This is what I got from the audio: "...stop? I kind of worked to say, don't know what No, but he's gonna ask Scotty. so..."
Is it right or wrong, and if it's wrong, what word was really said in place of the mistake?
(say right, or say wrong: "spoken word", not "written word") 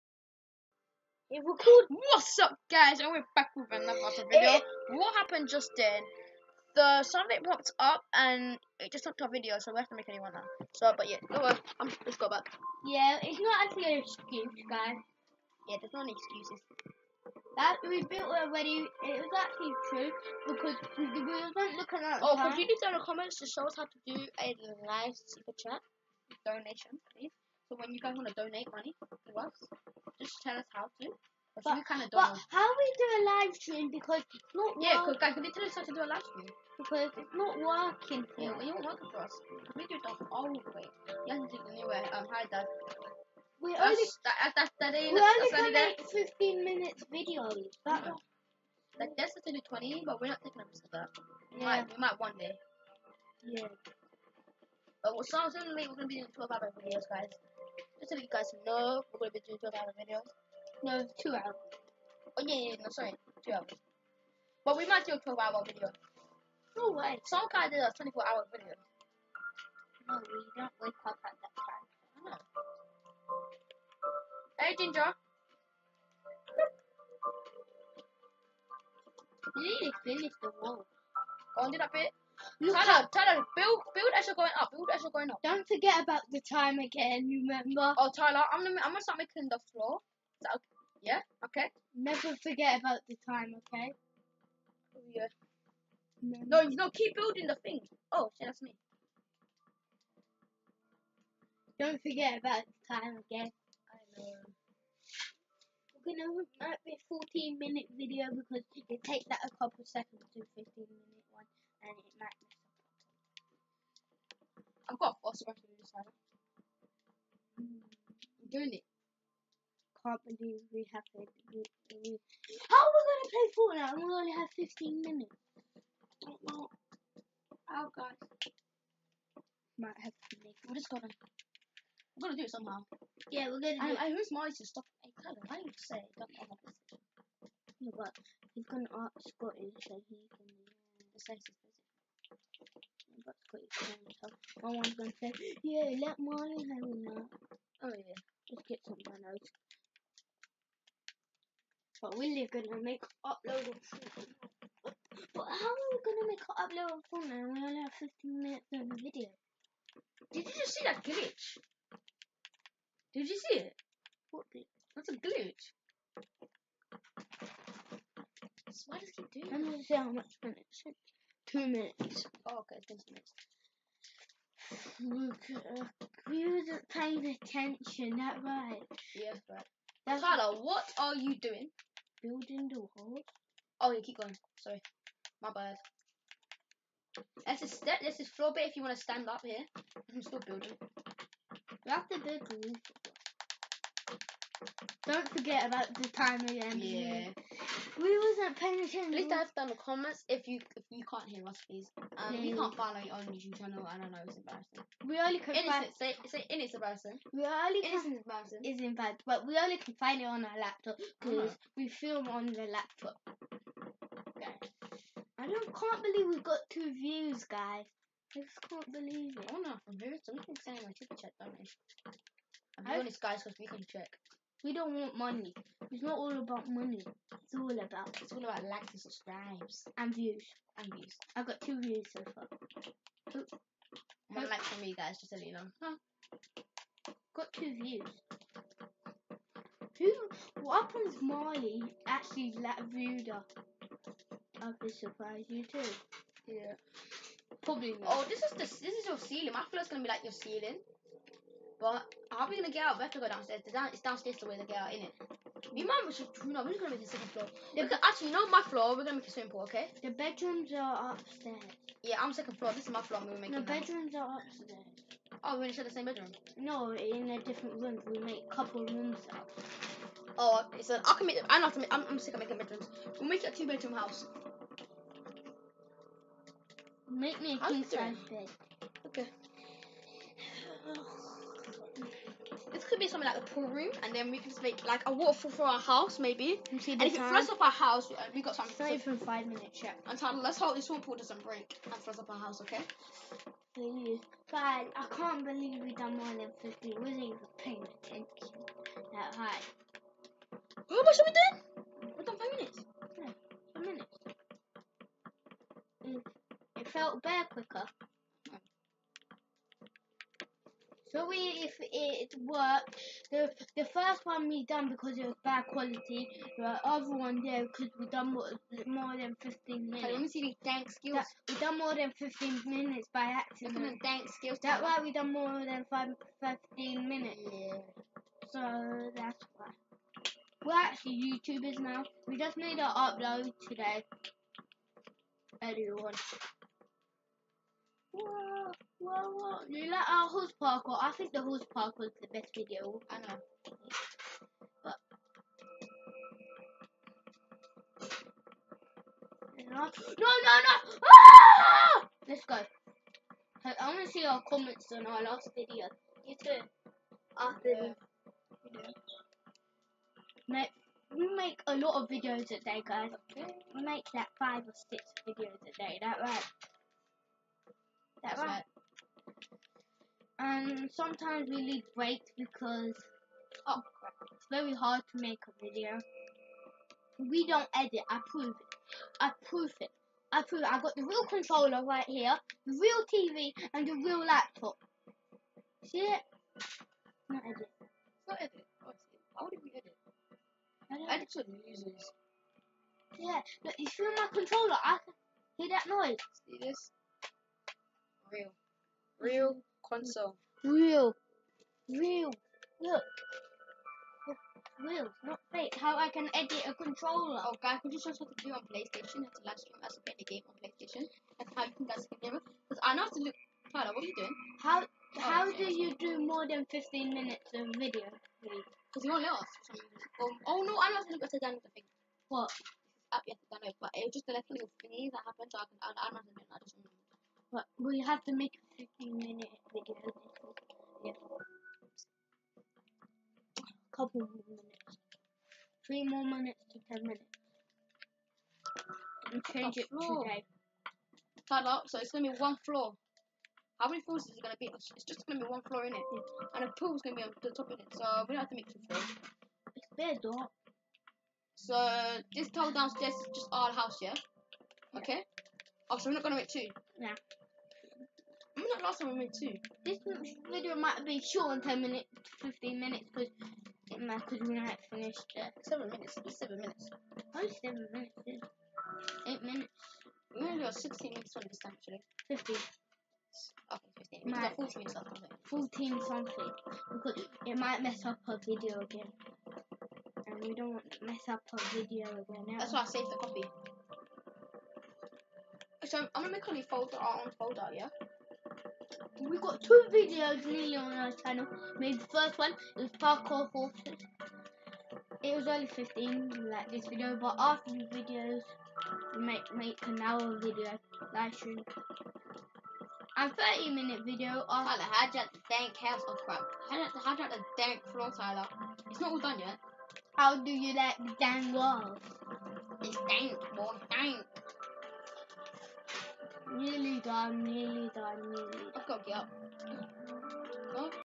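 wrong: "wanted", not "worked".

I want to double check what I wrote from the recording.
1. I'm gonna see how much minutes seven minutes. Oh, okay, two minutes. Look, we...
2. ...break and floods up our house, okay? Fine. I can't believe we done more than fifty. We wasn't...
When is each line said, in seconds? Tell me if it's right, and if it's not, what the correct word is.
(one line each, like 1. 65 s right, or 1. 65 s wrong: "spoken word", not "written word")
1. 169 s wrong: "two", not "seven"
2. 291 s right.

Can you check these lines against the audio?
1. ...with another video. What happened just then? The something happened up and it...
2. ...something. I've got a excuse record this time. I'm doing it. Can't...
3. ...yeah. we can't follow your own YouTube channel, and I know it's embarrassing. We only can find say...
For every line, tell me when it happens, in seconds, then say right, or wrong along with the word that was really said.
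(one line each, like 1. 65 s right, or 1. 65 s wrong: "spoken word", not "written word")
1. 3 s wrong: "popped", not "happened"
2. 112 s wrong: "false", not "excuse"
3. 202 s right.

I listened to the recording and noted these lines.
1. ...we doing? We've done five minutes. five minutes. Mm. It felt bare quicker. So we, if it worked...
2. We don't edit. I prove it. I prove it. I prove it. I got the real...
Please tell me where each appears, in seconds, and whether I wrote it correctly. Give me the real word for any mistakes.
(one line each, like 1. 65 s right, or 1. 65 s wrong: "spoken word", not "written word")
1. 301 s right
2. 377 s right.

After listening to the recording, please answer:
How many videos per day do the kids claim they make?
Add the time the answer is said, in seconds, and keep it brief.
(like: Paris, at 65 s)
five or six, at 364 s.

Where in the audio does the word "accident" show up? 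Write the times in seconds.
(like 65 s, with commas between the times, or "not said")
323 s.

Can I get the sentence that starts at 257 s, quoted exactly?
The, gonna, actually, you know my floor, we're gonna make a swimming pool, okay?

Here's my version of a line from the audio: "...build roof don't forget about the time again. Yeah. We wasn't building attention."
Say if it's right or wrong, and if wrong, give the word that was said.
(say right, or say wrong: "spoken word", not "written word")
wrong: "paying", not "building".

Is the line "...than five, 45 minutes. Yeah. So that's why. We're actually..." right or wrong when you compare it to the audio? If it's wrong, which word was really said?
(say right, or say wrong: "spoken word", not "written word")
wrong: "15", not "45".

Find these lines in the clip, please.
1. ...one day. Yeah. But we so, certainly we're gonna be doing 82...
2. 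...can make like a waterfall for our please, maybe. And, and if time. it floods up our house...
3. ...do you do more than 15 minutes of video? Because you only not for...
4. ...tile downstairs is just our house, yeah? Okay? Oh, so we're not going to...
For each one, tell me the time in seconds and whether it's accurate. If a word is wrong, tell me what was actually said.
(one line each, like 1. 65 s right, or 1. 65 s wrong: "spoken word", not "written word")
1. 52 s wrong: "12", not "82"
2. 284 s wrong: "house", not "please"
3. 415 s right
4. 452 s right.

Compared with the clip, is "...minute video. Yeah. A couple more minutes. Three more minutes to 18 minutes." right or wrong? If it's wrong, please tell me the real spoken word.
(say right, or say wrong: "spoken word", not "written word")
wrong: "10", not "18".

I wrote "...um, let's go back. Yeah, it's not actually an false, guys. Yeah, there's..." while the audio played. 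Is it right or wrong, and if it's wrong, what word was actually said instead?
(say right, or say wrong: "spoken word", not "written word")
wrong: "excuse", not "false".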